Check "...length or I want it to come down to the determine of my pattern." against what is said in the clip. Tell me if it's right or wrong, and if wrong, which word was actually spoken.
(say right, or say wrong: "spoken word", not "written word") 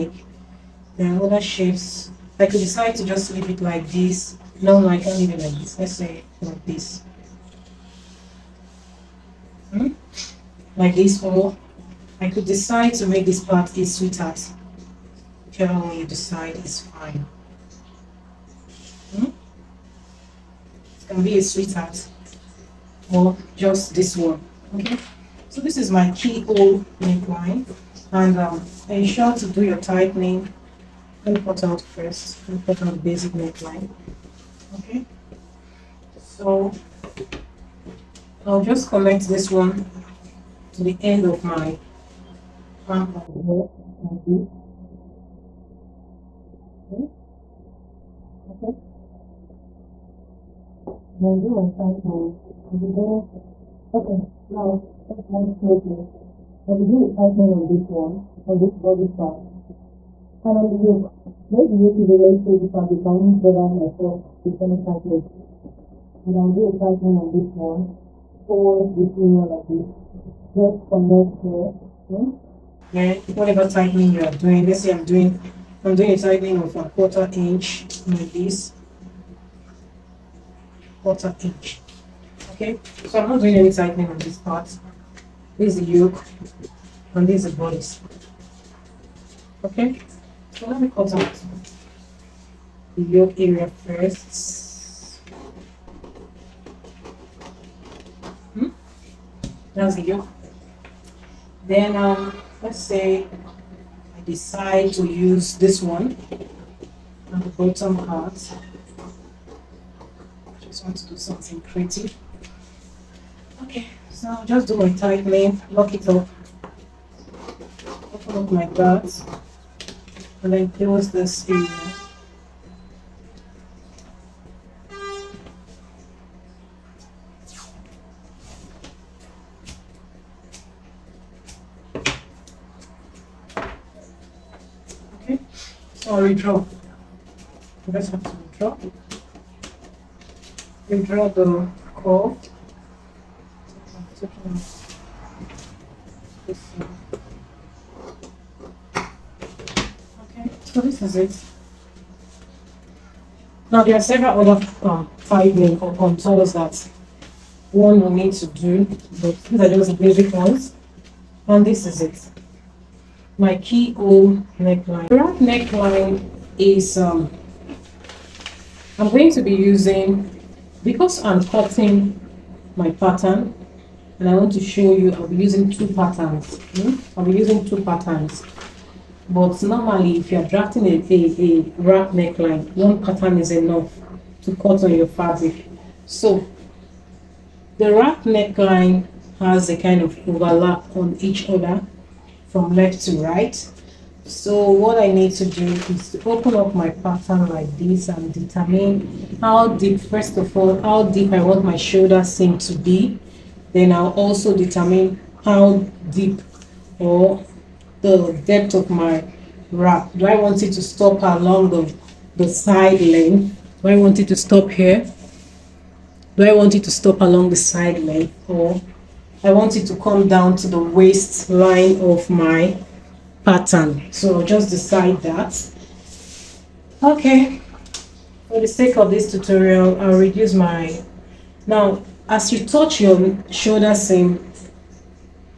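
wrong: "waistline", not "determine".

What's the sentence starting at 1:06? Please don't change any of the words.
But I'll do a tightening on this one towards this area like this.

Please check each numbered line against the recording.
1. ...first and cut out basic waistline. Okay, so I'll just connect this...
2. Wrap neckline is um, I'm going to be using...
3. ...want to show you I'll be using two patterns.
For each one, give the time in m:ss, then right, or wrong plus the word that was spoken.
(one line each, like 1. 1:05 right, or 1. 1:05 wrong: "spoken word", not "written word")
1. 0:31 wrong: "neckline", not "waistline"
2. 2:45 right
3. 2:54 right.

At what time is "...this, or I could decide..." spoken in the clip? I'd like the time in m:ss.
0:10.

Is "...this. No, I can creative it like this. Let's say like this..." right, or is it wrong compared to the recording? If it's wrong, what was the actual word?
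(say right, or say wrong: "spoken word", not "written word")
wrong: "leave", not "creative".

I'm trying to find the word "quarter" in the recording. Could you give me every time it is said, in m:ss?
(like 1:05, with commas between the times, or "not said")
1:16, 1:21.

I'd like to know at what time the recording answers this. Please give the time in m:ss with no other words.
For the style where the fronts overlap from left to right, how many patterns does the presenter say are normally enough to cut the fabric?
3:02.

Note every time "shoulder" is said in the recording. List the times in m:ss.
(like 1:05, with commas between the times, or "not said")
3:21, 3:53.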